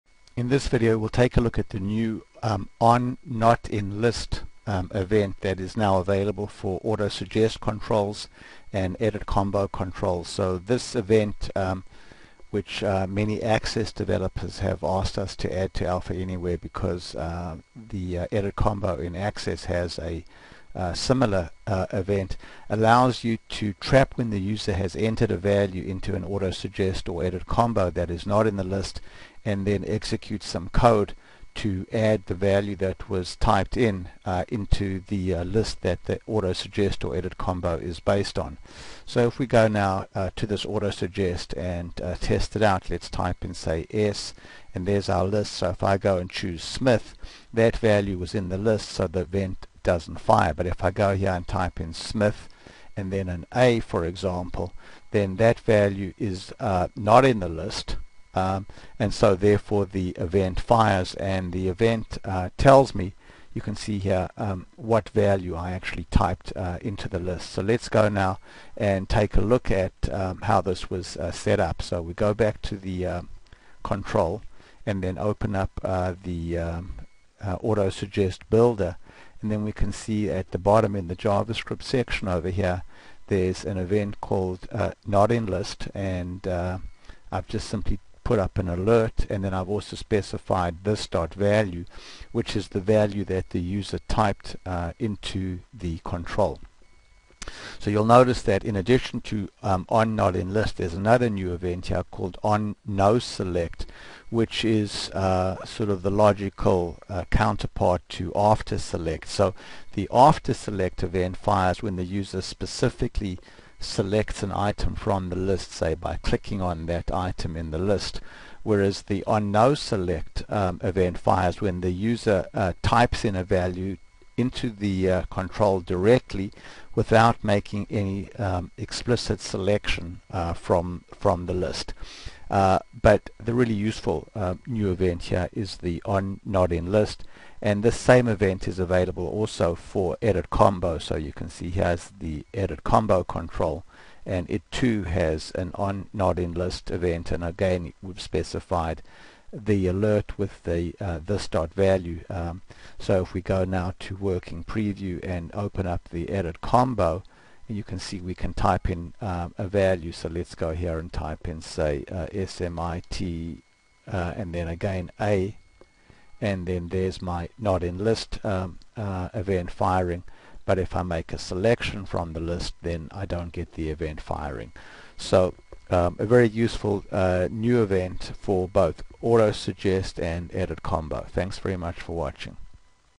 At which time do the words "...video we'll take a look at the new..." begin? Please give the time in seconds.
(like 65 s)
0 s.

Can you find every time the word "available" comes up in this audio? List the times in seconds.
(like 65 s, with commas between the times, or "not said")
5 s, 138 s.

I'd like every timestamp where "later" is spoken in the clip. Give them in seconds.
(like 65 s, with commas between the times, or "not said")
not said.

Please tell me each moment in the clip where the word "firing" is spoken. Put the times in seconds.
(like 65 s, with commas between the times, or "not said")
169 s, 174 s.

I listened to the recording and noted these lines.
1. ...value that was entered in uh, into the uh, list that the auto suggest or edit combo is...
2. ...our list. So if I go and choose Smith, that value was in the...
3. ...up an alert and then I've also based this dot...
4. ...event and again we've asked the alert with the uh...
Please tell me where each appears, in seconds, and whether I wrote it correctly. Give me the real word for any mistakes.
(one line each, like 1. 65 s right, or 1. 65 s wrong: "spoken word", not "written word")
1. 32 s wrong: "typed", not "entered"
2. 45 s right
3. 88 s wrong: "specified", not "based"
4. 146 s wrong: "specified", not "asked".